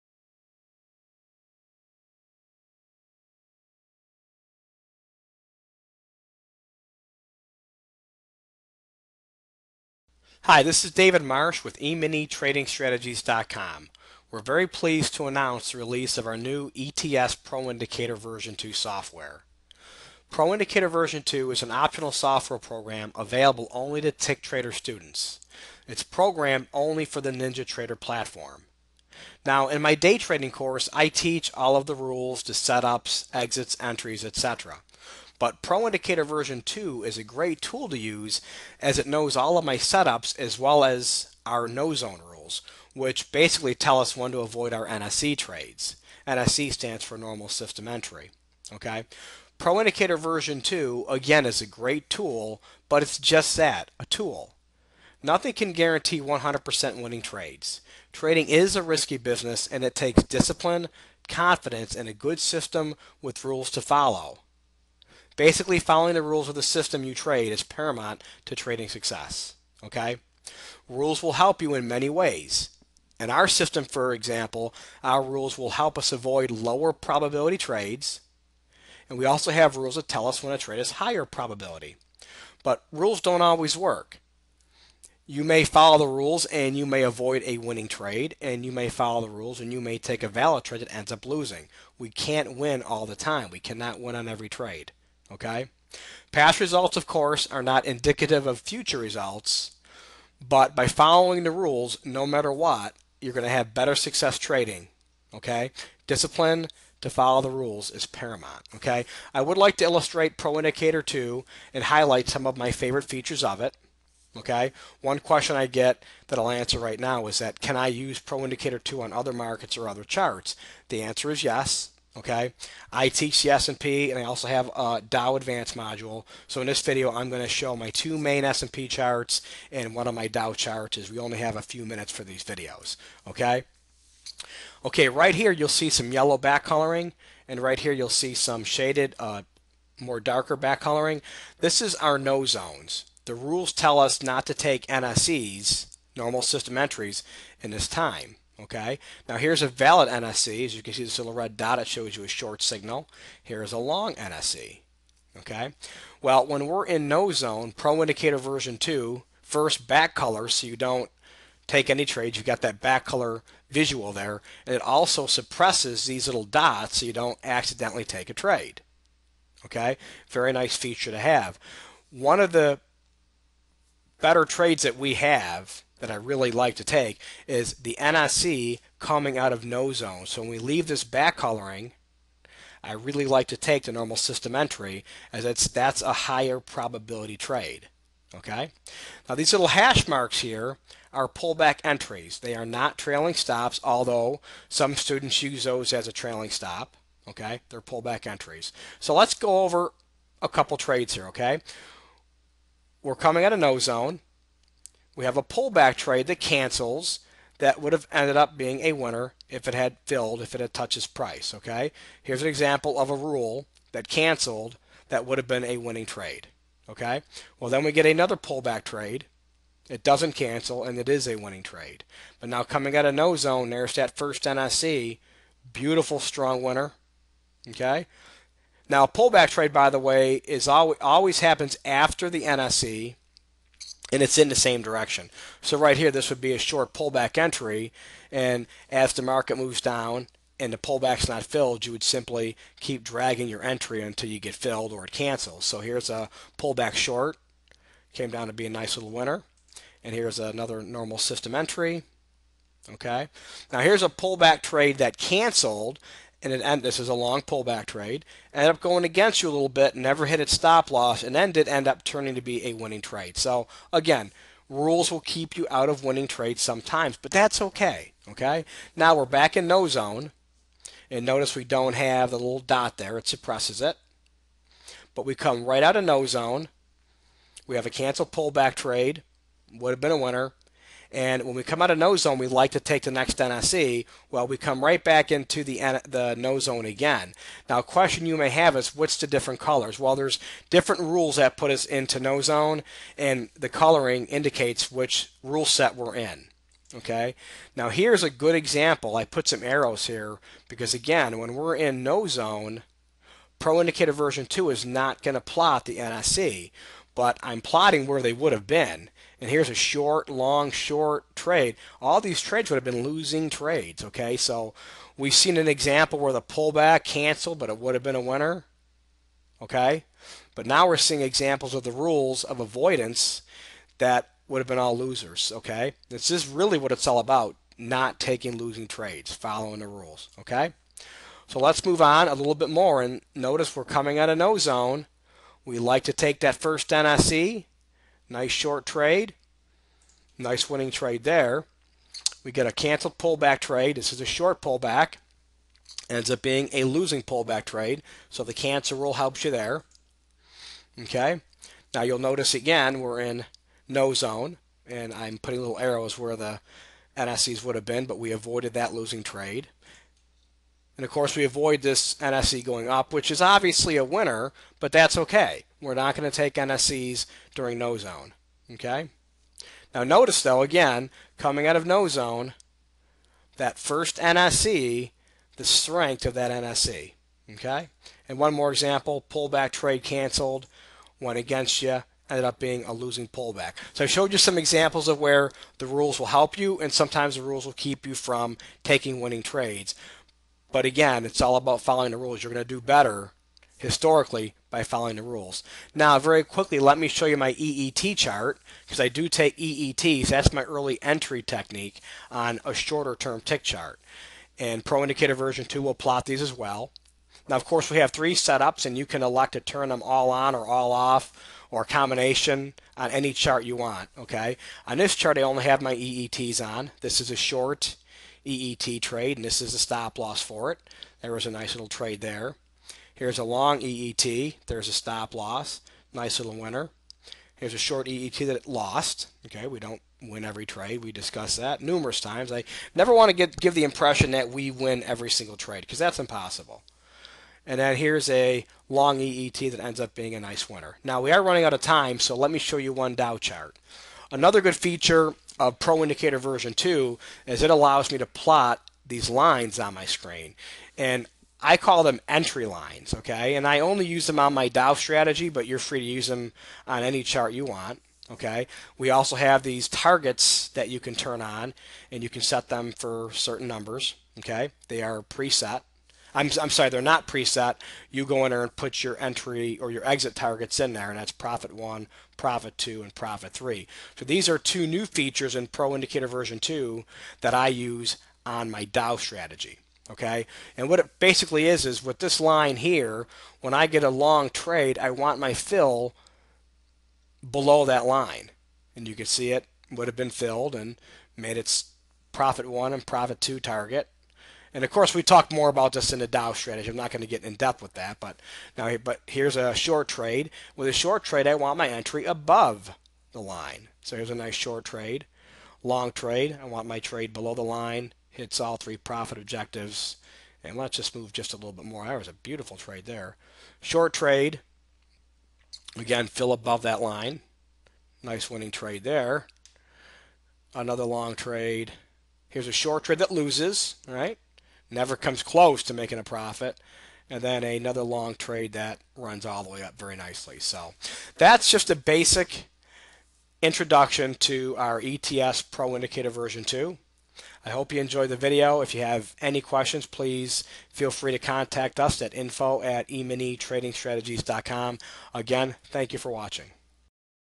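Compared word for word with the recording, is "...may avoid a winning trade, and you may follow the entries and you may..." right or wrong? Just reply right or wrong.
wrong.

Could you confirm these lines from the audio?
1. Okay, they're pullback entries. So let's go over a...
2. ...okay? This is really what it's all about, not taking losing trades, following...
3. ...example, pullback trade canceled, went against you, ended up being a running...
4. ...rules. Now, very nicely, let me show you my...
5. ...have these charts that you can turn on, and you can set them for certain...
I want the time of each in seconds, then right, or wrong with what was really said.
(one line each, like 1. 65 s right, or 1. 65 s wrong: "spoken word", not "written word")
1. 197 s right
2. 325 s right
3. 378 s wrong: "losing", not "running"
4. 395 s wrong: "quickly", not "nicely"
5. 459 s wrong: "targets", not "charts".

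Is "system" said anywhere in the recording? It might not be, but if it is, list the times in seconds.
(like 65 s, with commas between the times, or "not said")
47 s, 62 s, 66 s, 73 s, 146 s, 184 s, 251 s.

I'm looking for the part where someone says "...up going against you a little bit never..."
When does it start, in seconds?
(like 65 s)
258 s.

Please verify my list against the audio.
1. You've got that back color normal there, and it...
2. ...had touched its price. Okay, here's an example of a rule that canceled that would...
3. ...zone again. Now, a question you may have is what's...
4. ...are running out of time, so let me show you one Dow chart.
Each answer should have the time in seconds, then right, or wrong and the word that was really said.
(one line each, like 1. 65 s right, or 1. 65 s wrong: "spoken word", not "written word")
1. 162 s wrong: "visual", not "normal"
2. 210 s right
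3. 286 s right
4. 441 s right.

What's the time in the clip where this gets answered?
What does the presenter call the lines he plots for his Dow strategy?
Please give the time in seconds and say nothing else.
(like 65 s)
452 s.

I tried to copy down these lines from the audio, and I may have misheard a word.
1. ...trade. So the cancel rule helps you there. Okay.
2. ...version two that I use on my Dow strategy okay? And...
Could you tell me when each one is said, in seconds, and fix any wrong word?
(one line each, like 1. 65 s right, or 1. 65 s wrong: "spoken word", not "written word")
1. 347 s right
2. 476 s right.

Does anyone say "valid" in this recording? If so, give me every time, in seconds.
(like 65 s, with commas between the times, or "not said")
90 s, 149 s.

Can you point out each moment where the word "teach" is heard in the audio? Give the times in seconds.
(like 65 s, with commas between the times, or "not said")
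31 s, 123 s.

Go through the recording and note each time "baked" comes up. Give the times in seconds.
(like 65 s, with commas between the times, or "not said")
not said.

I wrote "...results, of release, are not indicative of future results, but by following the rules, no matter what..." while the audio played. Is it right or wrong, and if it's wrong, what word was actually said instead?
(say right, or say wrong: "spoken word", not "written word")
wrong: "course", not "release".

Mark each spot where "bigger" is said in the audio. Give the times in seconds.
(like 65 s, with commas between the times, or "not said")
not said.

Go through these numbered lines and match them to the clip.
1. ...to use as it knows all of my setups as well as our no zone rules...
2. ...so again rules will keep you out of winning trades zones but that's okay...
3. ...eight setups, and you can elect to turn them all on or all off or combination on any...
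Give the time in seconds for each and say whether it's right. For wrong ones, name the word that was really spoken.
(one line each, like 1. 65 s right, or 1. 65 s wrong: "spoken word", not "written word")
1. 37 s right
2. 263 s wrong: "sometimes", not "zones"
3. 408 s wrong: "three", not "eight".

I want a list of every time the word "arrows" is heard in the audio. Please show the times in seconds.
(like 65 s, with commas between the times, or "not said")
299 s, 355 s.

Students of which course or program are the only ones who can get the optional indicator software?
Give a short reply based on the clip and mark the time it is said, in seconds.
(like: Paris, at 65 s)
Tick Trader, at 24 s.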